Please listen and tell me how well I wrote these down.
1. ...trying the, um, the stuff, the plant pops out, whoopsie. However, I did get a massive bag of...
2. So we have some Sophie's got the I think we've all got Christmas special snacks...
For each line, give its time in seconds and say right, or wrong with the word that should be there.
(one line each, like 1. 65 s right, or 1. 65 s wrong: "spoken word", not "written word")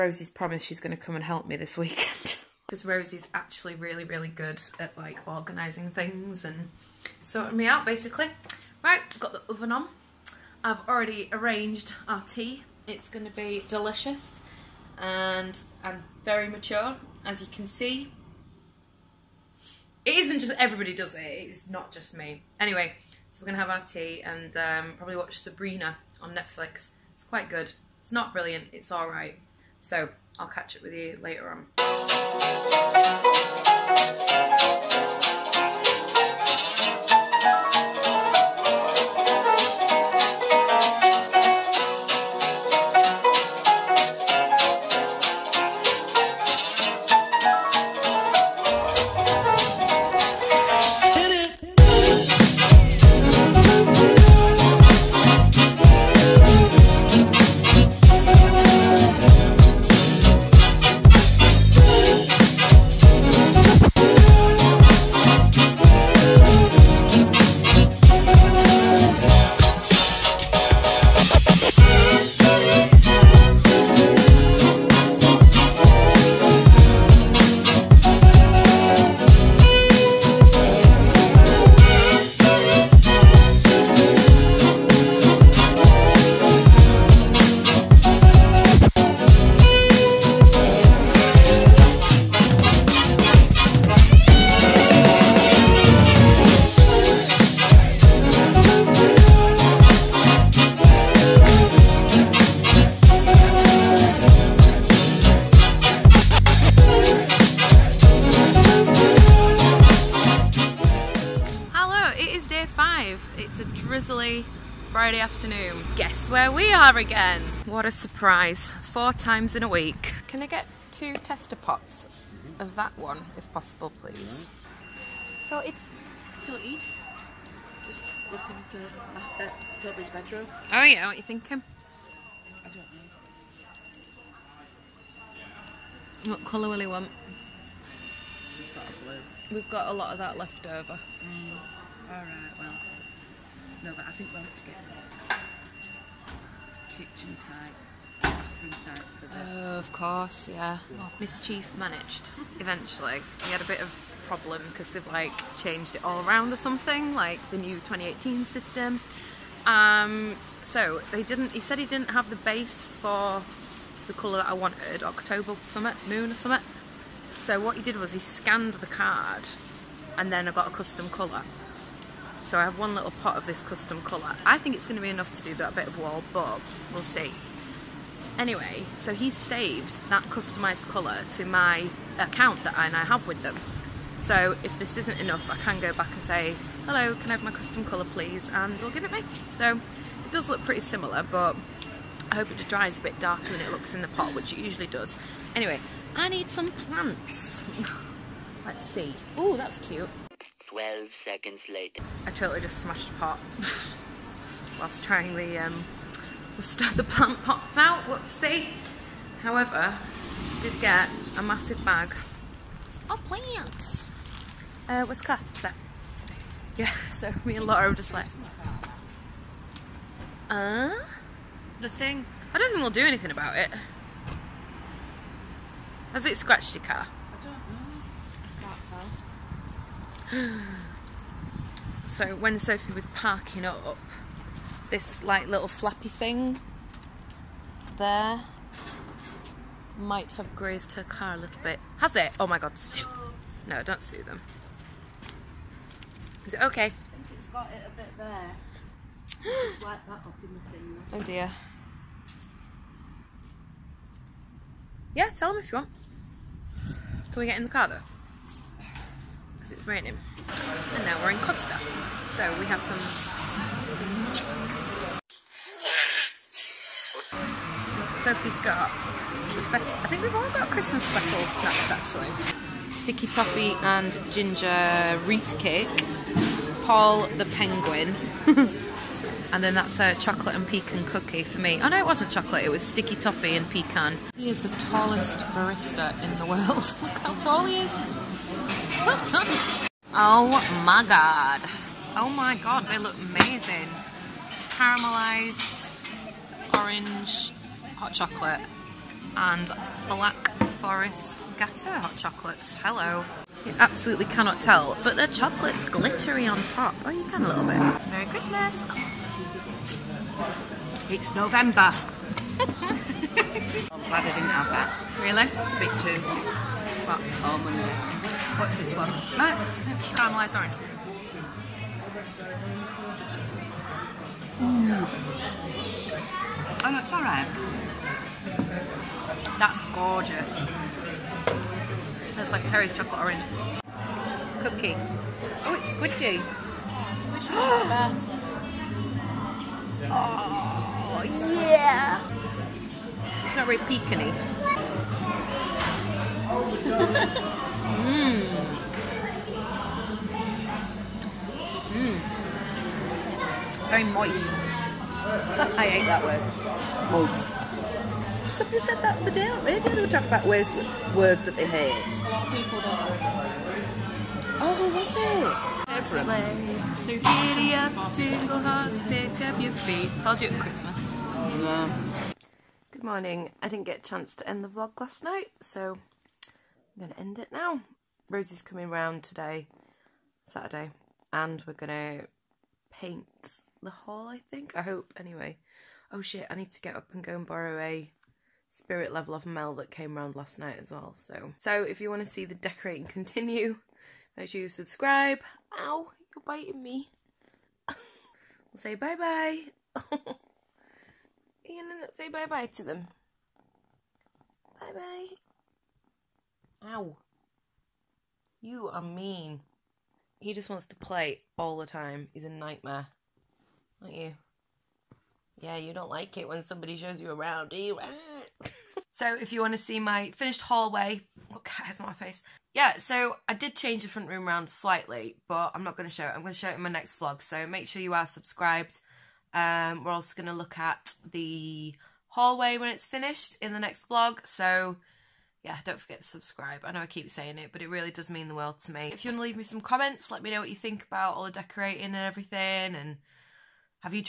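1. 205 s right
2. 262 s right.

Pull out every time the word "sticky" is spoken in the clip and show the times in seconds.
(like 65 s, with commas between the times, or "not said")
272 s, 282 s.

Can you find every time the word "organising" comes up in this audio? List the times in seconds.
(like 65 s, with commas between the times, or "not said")
5 s.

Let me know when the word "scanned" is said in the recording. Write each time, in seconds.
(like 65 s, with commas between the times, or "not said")
168 s.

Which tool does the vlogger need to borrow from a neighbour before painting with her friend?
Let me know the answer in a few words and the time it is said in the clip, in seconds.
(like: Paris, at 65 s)
Spirit level, at 388 s.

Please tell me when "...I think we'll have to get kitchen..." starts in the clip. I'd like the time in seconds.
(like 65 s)
144 s.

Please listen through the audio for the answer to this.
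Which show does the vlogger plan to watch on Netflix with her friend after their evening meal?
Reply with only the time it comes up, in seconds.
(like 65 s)
25 s.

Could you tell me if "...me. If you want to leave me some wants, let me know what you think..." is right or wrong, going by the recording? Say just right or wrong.
wrong.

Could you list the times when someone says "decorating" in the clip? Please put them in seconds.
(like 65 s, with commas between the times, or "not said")
392 s, 441 s.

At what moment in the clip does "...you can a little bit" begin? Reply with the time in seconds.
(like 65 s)
307 s.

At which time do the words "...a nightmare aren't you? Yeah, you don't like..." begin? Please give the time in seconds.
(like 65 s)
412 s.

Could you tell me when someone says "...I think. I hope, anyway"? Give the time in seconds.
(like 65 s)
384 s.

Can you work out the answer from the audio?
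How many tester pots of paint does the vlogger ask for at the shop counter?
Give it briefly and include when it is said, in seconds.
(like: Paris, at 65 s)
2, at 120 s.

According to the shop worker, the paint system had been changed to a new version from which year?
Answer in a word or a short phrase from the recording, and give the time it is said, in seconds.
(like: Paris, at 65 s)
2018, at 157 s.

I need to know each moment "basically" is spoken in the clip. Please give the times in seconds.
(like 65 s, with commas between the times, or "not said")
7 s.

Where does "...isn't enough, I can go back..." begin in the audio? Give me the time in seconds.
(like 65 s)
184 s.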